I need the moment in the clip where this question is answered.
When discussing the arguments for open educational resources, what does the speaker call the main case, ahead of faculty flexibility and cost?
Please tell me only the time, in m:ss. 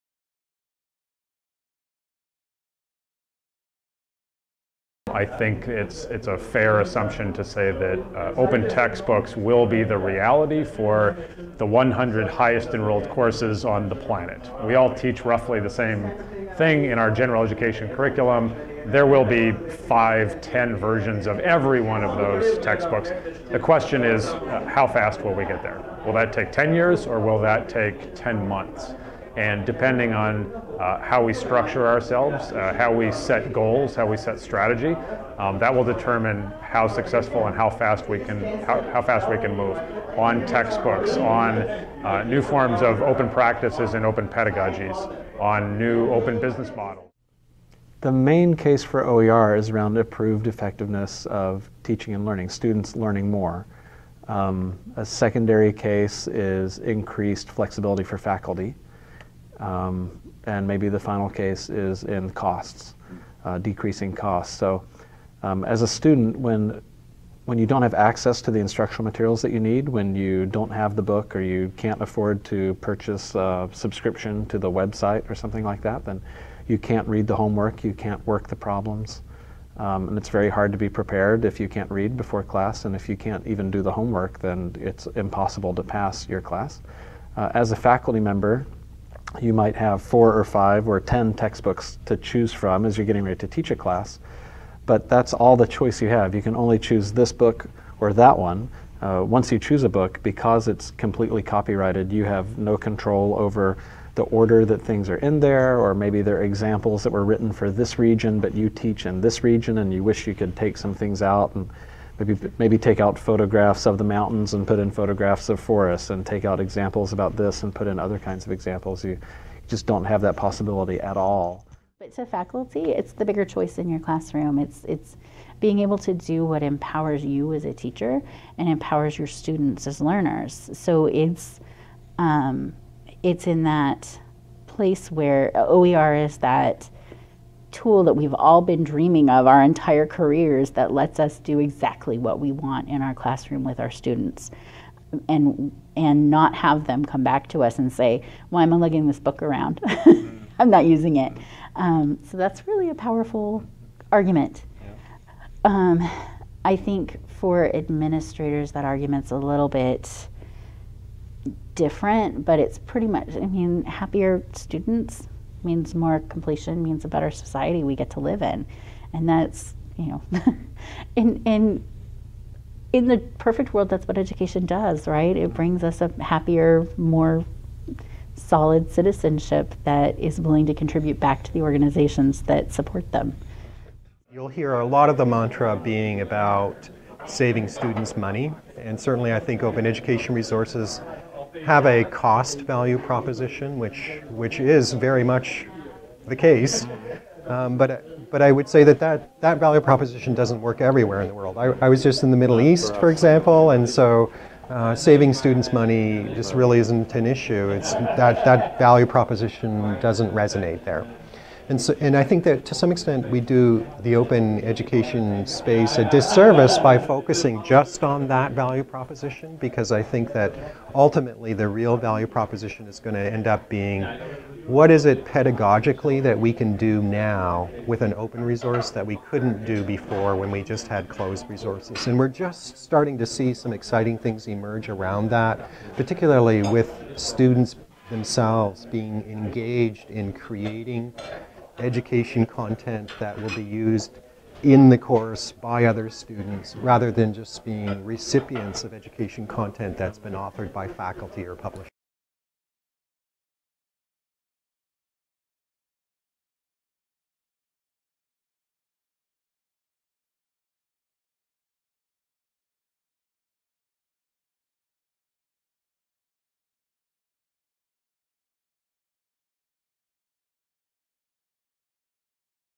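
0:49.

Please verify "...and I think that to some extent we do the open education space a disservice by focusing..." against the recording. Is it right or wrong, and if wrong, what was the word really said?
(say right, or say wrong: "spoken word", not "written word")
right.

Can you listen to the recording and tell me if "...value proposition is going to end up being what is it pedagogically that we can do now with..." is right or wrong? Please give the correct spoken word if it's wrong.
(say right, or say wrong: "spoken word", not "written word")
right.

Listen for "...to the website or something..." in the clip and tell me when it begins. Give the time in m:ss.
1:14.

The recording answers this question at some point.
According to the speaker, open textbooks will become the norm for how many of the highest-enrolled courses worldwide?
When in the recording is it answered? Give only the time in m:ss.
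0:11.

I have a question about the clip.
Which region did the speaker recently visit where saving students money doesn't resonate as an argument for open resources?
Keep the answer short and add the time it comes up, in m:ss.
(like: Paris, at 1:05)
The Middle East, at 3:22.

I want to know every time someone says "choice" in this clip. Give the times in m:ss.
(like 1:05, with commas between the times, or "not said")
1:35, 2:03.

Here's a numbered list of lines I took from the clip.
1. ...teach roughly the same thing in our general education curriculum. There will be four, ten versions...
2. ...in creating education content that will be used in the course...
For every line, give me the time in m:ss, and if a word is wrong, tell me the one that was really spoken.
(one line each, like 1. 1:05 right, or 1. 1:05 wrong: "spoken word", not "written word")
1. 0:14 wrong: "five", not "four"
2. 4:00 right.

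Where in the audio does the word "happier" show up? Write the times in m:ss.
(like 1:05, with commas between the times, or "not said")
2:43, 2:56.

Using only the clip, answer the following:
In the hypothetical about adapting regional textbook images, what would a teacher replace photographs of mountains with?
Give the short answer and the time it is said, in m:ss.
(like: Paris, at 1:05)
Forests, at 1:55.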